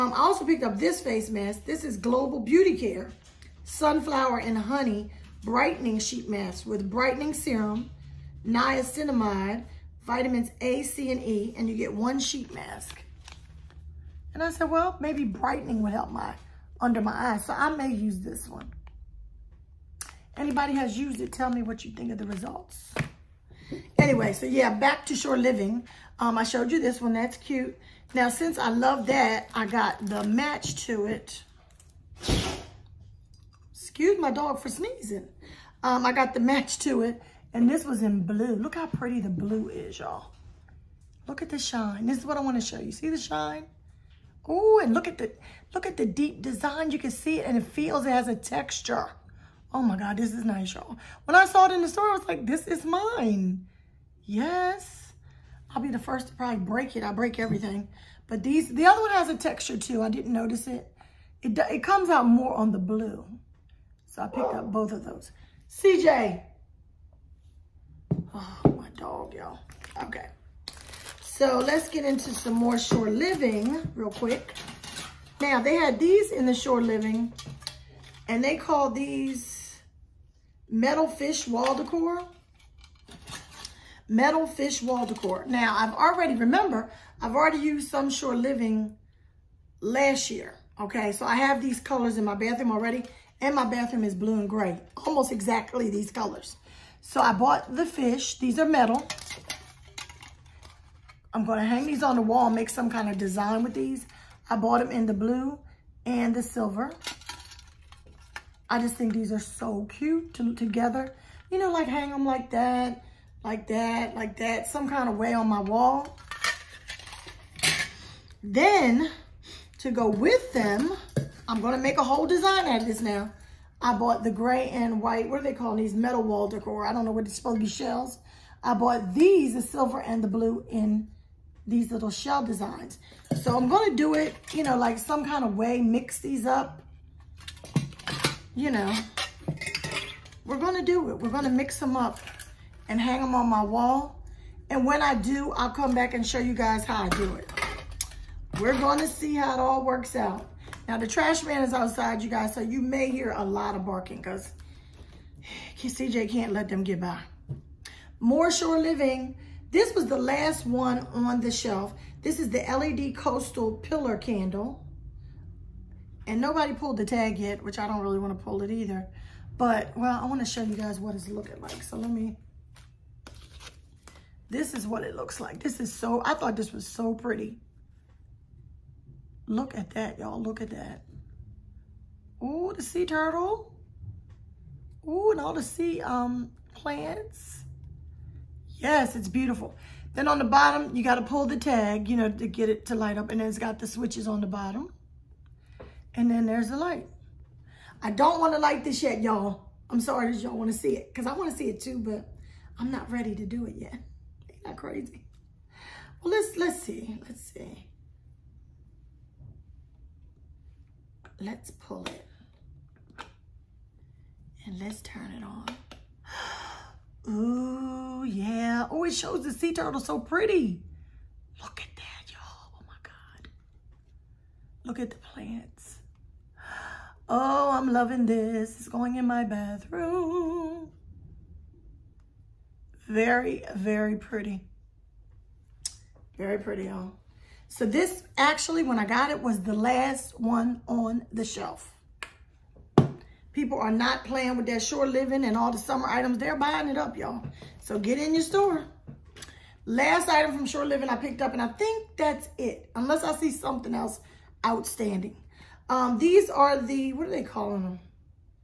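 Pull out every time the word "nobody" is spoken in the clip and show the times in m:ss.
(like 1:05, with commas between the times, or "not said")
2:46.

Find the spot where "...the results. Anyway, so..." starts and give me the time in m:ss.
0:22.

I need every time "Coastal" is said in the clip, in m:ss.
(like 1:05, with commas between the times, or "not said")
2:43.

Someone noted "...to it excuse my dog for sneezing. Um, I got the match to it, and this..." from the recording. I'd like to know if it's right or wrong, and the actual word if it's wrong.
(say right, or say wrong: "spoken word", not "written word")
right.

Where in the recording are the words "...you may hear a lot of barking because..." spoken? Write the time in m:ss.
2:32.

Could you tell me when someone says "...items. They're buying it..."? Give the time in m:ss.
4:06.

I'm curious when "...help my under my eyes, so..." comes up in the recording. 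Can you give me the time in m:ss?
0:15.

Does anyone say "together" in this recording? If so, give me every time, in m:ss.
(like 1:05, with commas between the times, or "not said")
1:50.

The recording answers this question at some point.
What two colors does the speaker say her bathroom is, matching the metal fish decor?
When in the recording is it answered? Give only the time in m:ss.
1:34.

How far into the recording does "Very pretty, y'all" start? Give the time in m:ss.
3:56.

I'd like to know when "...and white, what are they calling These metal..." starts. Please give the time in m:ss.
2:04.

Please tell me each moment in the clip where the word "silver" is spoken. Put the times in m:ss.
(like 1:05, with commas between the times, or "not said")
1:46, 2:09.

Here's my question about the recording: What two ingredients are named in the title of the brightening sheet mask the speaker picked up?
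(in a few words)
Sunflower and Honey.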